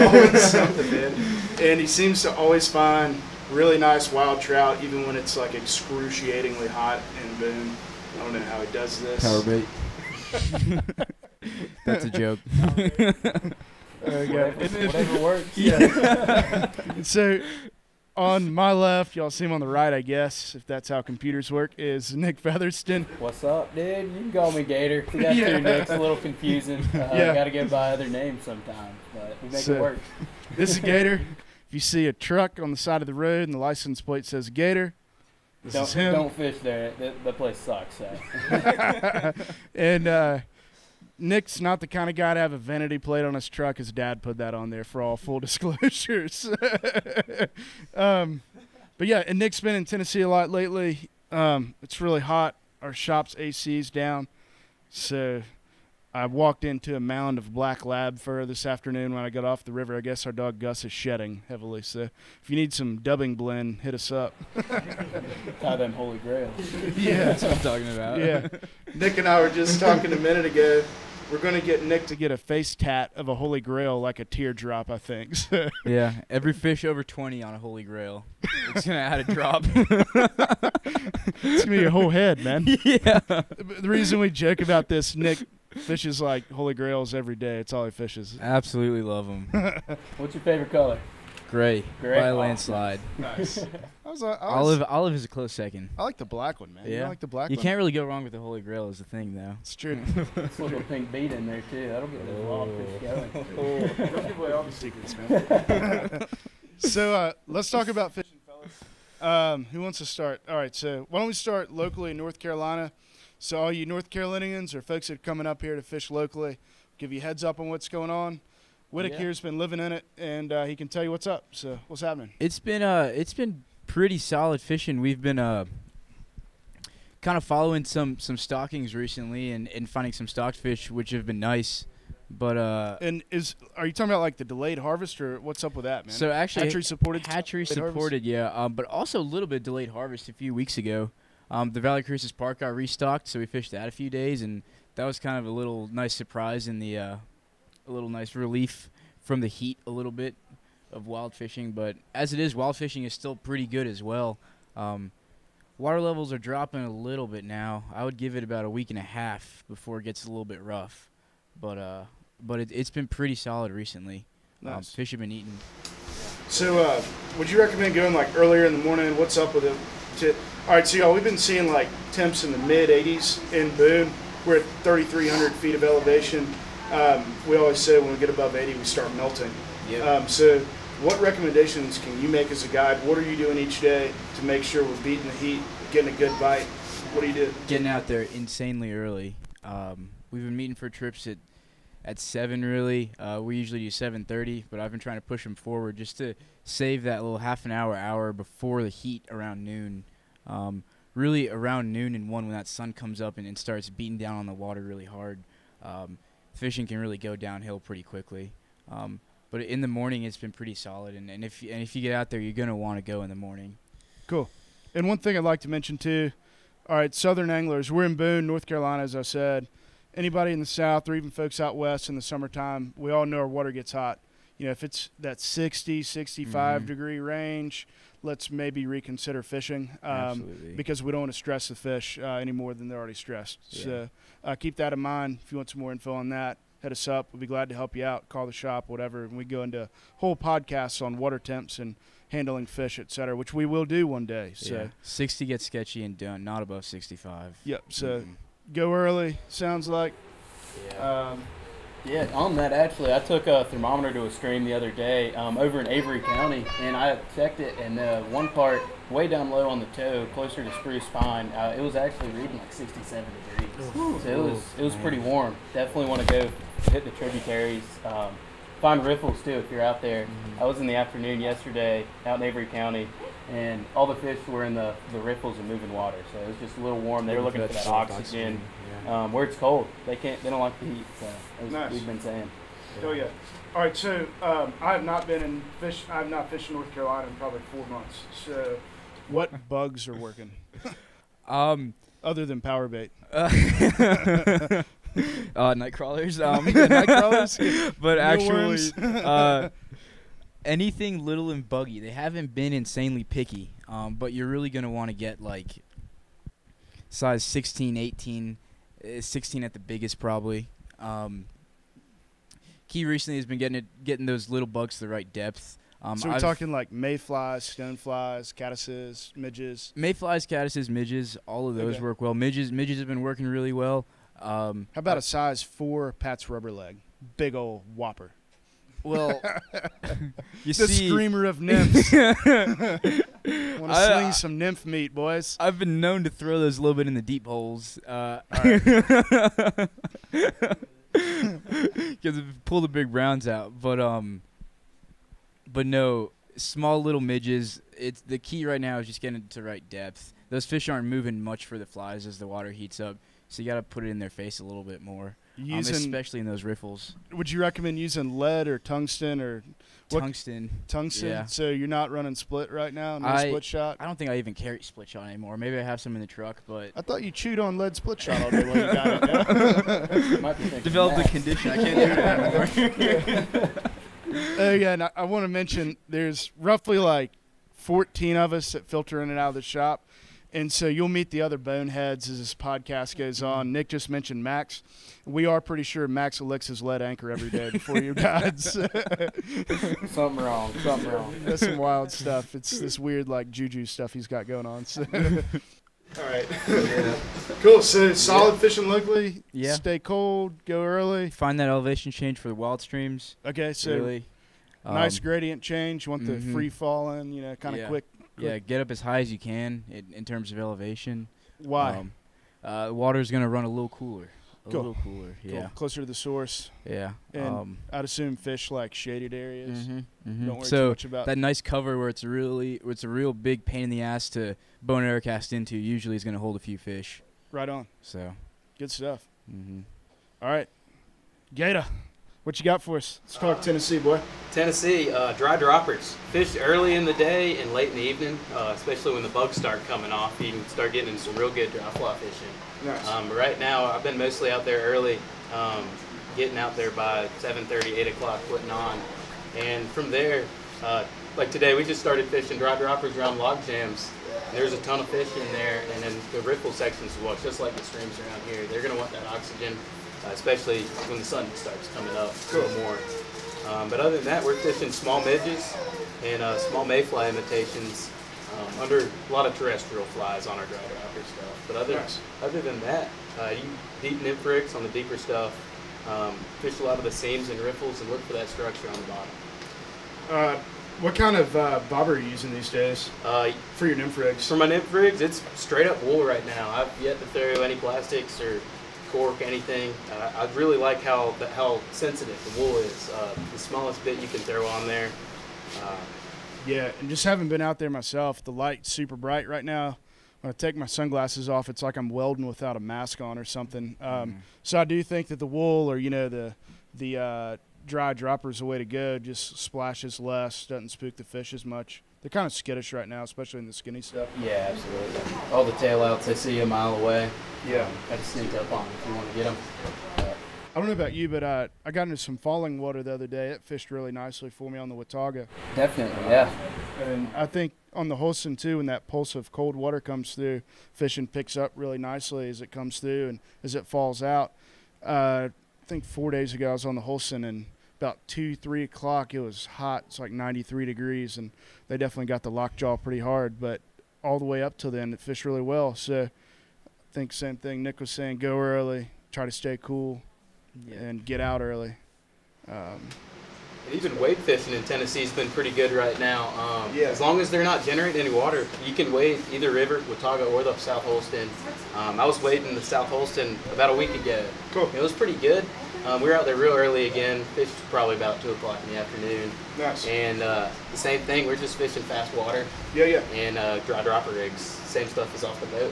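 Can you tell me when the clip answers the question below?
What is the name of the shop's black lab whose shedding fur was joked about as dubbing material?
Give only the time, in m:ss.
1:00.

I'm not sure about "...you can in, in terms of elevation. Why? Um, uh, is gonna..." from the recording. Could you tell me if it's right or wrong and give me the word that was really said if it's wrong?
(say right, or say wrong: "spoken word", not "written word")
right.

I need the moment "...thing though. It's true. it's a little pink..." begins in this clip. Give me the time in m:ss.
1:39.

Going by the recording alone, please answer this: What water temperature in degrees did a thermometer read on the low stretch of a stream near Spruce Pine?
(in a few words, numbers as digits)
67.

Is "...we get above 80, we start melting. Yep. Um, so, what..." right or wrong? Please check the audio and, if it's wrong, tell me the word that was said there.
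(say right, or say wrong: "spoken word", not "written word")
right.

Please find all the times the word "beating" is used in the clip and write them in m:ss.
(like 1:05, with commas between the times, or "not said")
3:04, 3:23.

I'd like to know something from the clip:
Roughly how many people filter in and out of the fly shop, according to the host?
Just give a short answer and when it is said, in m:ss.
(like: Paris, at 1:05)
14, at 6:17.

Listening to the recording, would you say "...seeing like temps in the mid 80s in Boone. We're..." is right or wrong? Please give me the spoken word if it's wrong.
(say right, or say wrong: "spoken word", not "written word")
right.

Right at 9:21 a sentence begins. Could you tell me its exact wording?
Um, I was wading the South Holston about a week ago.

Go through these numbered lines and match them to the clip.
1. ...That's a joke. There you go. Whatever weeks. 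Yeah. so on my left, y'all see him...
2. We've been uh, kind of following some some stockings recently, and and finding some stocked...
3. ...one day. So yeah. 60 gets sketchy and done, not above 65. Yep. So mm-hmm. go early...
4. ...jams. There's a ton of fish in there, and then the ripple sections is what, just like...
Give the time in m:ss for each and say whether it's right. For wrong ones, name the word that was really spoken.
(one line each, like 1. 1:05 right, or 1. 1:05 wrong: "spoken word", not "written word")
1. 0:11 wrong: "works", not "weeks"
2. 2:04 right
3. 4:04 right
4. 7:33 right.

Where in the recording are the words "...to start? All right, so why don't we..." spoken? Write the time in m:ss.
1:49.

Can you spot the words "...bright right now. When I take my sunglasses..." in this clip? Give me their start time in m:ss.
8:19.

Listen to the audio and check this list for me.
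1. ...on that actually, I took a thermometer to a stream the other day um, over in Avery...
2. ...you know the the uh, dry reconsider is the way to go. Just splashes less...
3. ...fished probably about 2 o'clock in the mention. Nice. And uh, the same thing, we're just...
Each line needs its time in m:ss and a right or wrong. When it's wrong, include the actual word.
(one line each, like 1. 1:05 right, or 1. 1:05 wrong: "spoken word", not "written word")
1. 4:12 right
2. 8:25 wrong: "dropper", not "reconsider"
3. 9:27 wrong: "afternoon", not "mention".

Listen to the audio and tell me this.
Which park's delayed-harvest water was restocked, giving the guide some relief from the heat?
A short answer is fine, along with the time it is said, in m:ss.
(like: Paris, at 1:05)
Valle Crucis Park, at 2:21.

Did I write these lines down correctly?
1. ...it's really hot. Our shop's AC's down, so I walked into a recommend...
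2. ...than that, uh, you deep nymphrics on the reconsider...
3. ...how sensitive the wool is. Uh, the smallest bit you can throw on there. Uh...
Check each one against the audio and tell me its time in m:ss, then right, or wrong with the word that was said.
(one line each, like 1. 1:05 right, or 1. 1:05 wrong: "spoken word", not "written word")
1. 0:51 wrong: "mound", not "recommend"
2. 7:52 wrong: "deeper", not "reconsider"
3. 8:11 right.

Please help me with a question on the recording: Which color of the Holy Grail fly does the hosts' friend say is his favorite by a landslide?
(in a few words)
Gray.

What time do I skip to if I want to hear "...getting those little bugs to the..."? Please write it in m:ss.
5:14.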